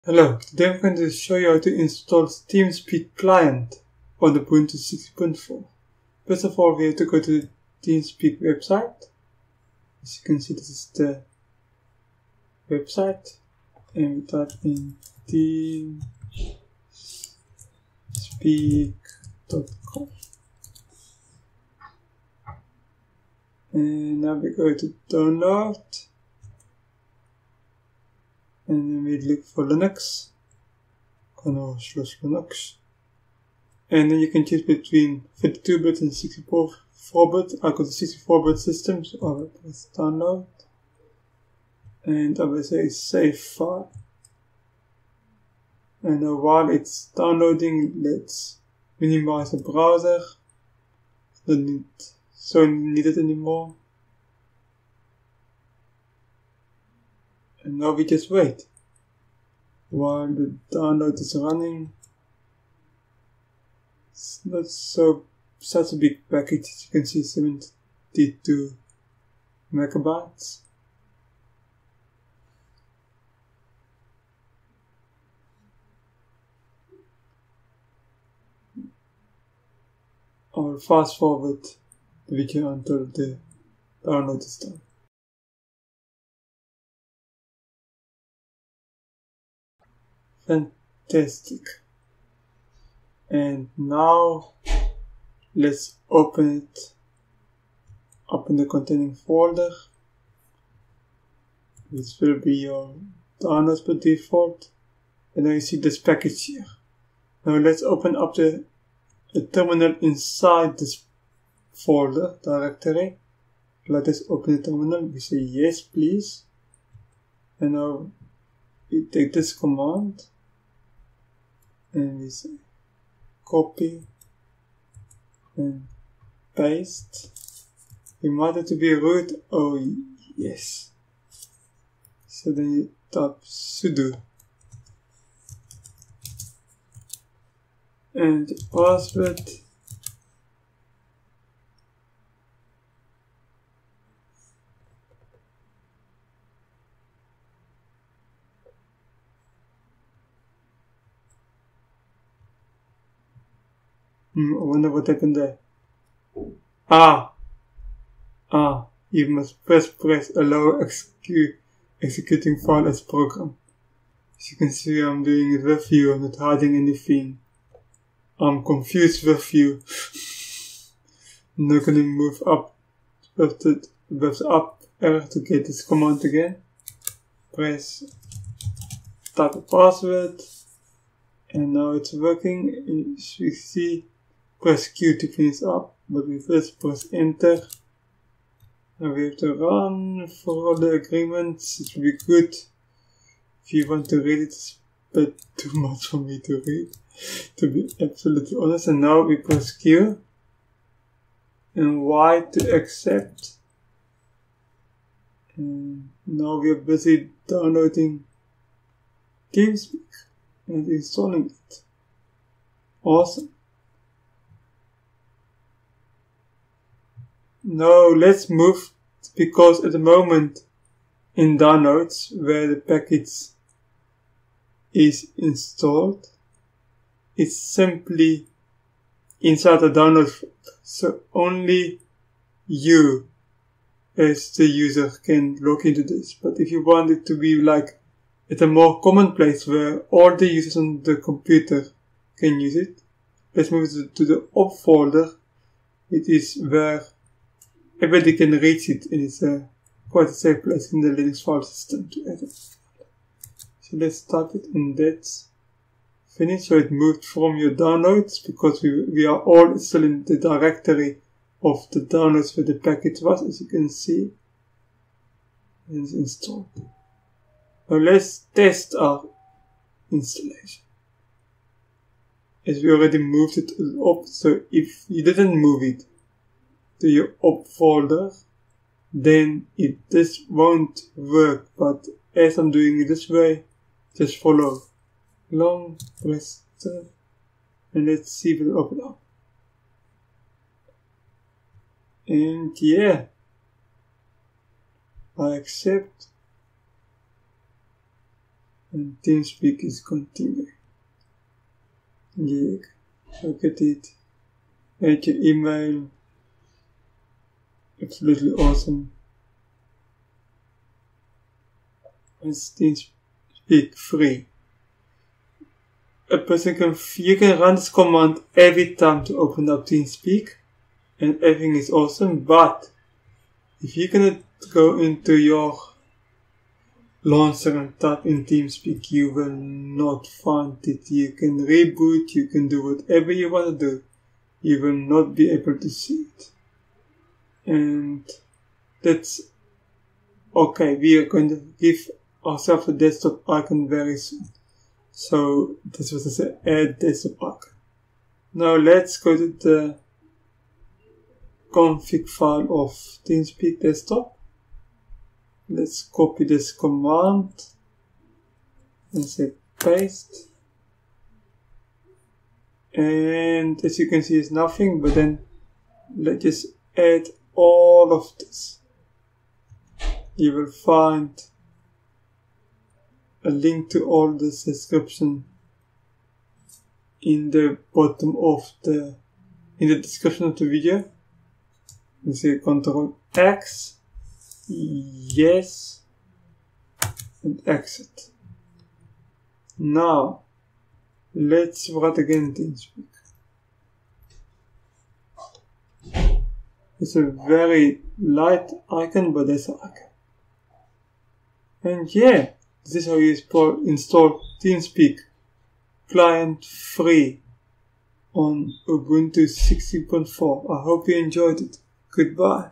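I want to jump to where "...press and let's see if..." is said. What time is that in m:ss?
4:46.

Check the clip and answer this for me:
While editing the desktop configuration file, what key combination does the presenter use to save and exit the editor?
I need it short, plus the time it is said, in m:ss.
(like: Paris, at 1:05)
Control X, at 6:22.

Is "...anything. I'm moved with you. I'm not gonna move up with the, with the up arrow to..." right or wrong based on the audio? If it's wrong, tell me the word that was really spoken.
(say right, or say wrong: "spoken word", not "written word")
wrong: "confused", not "moved".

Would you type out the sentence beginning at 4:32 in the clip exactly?
As we already moved it up, so if you didn't move it, to your opt folder, then it just won't work.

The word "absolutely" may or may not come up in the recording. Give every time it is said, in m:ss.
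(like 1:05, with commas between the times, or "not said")
3:17, 5:08.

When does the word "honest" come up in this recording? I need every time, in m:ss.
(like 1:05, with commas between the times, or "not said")
3:18.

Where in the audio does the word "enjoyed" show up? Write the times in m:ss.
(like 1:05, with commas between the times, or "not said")
6:51.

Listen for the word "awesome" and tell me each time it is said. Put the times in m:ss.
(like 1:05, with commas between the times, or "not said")
3:33, 5:08, 5:21.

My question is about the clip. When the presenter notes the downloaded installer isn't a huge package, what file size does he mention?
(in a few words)
72 megabytes.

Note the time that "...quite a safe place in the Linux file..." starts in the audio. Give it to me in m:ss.
4:10.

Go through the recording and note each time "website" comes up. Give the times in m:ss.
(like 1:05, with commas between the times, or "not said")
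0:08, 0:12.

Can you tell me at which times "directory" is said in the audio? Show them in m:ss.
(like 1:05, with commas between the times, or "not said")
1:52, 4:20.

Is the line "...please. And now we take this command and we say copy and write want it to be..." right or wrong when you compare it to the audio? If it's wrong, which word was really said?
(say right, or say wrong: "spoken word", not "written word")
wrong: "paste", not "write".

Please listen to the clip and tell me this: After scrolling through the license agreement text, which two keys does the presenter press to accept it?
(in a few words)
Q and Y.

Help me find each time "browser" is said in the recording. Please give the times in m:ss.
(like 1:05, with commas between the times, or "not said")
0:49.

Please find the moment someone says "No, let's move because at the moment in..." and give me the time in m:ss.
3:37.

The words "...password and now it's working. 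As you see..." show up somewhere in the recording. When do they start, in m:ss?
2:59.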